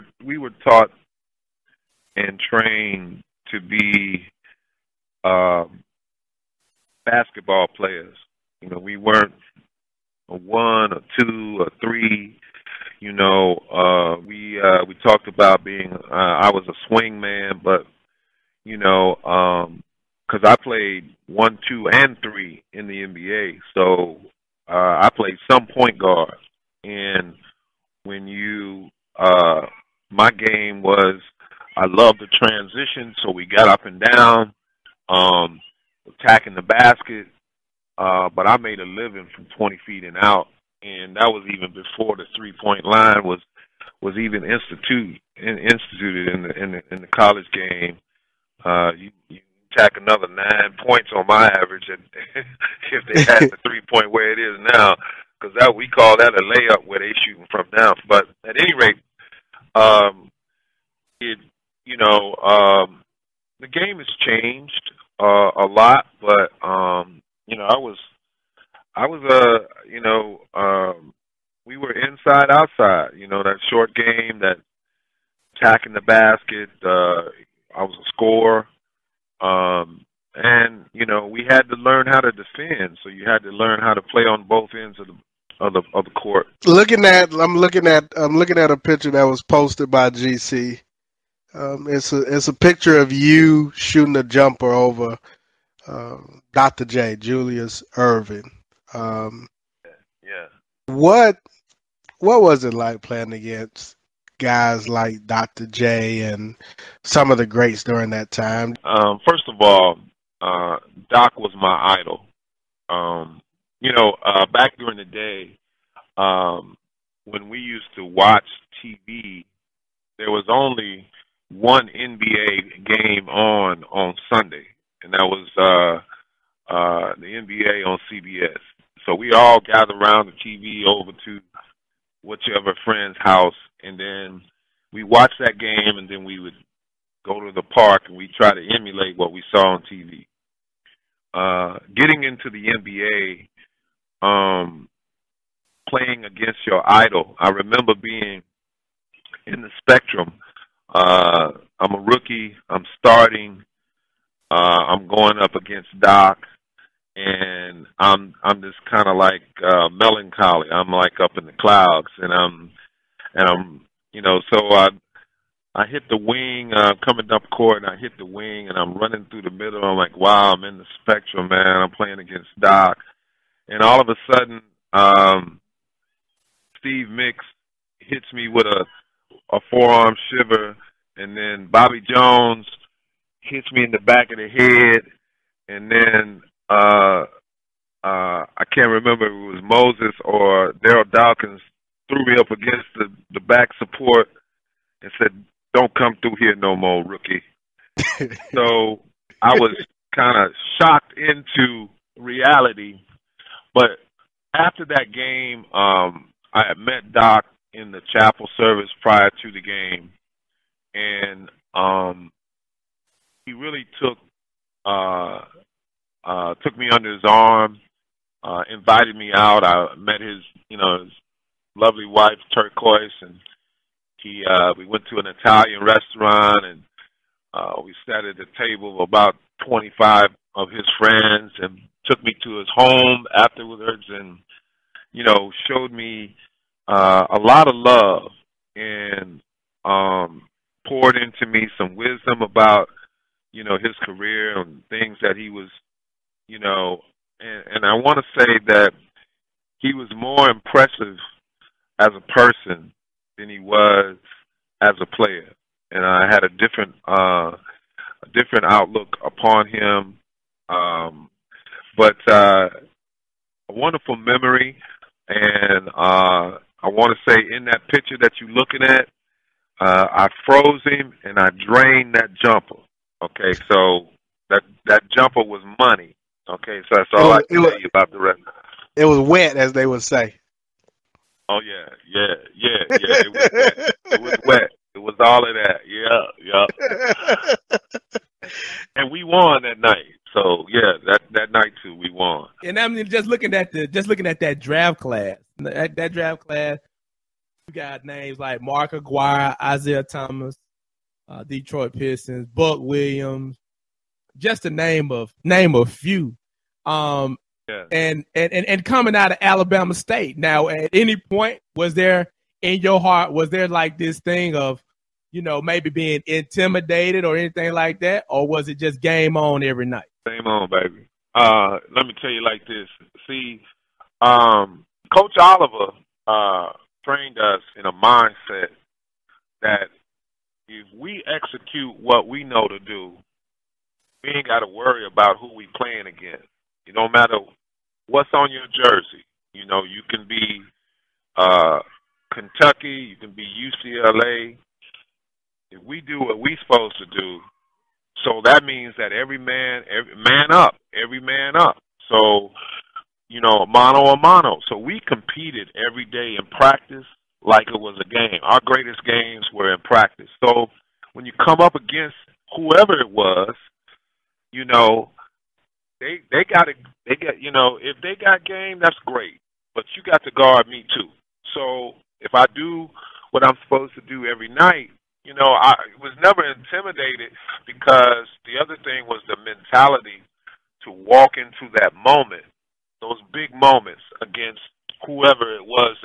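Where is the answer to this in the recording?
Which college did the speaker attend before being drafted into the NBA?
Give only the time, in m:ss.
5:09.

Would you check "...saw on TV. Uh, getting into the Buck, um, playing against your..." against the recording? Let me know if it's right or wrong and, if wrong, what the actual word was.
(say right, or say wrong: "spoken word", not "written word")
wrong: "NBA", not "Buck".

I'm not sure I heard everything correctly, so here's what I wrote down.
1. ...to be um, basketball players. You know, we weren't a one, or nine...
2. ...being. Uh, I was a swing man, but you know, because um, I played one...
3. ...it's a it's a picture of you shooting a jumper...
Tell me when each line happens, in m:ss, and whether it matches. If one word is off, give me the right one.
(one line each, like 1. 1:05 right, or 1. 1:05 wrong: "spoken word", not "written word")
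1. 0:03 wrong: "two", not "nine"
2. 0:15 right
3. 1:31 right.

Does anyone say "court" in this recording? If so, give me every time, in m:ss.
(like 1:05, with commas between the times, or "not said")
1:26, 2:47.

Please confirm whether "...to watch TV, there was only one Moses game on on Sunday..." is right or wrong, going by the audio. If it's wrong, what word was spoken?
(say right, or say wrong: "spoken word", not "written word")
wrong: "NBA", not "Moses".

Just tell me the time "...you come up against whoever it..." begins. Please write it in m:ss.
6:01.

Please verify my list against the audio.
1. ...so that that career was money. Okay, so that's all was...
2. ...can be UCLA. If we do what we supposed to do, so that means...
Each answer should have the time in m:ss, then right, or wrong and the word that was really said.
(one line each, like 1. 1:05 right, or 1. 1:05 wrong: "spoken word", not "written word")
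1. 4:33 wrong: "jumper", not "career"
2. 5:43 right.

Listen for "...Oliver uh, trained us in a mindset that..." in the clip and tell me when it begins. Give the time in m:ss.
5:25.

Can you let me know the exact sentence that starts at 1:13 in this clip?
You know, that short game, that attacking the basket.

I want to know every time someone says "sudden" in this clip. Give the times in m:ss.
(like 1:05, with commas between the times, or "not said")
2:54.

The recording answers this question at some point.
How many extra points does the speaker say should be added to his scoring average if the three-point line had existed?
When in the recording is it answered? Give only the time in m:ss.
0:50.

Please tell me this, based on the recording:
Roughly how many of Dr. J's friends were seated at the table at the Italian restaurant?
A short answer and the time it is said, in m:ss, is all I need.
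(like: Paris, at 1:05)
25, at 3:49.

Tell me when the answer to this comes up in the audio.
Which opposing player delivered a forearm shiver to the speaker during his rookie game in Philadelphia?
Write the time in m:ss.
2:56.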